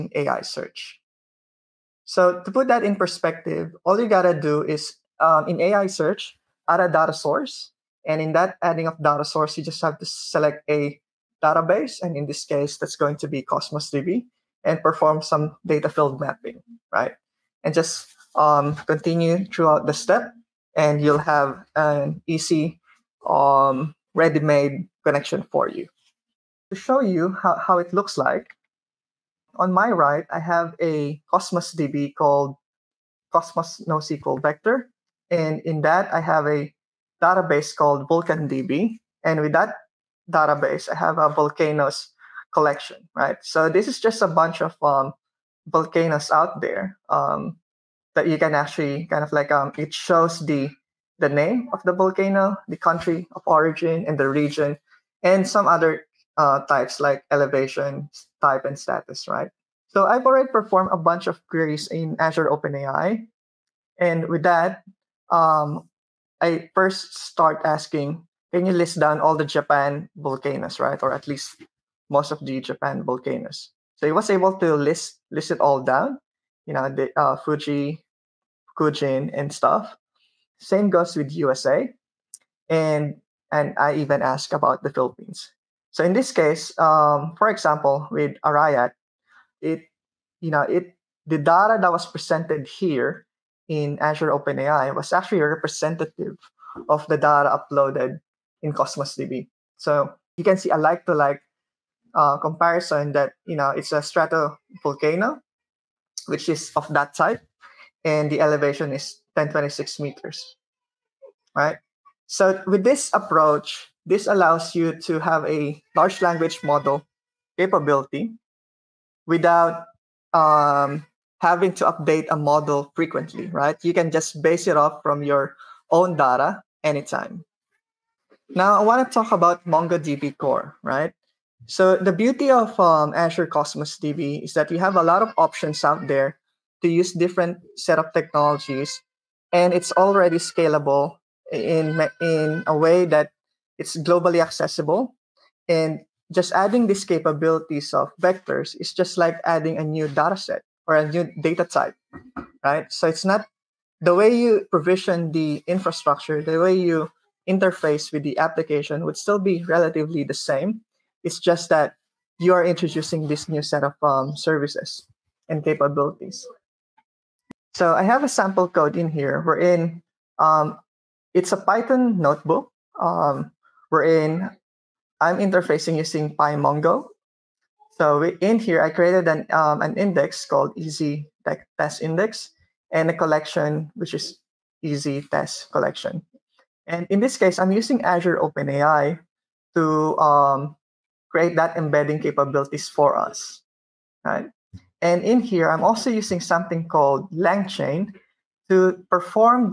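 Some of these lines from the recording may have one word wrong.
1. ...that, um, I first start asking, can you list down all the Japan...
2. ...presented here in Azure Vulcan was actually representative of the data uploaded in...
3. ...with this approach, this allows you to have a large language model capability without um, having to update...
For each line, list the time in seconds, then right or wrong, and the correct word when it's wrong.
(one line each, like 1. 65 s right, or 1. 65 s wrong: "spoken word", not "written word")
1. 64 s right
2. 92 s wrong: "OpenAI", not "Vulcan"
3. 112 s right.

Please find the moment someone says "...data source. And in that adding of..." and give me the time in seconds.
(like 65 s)
6 s.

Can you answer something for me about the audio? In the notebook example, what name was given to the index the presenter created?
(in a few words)
easy test index.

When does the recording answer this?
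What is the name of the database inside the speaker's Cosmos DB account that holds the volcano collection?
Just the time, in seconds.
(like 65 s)
38 s.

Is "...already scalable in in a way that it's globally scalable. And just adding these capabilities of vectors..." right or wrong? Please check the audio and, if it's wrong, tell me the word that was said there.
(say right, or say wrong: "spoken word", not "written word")
wrong: "accessible", not "scalable".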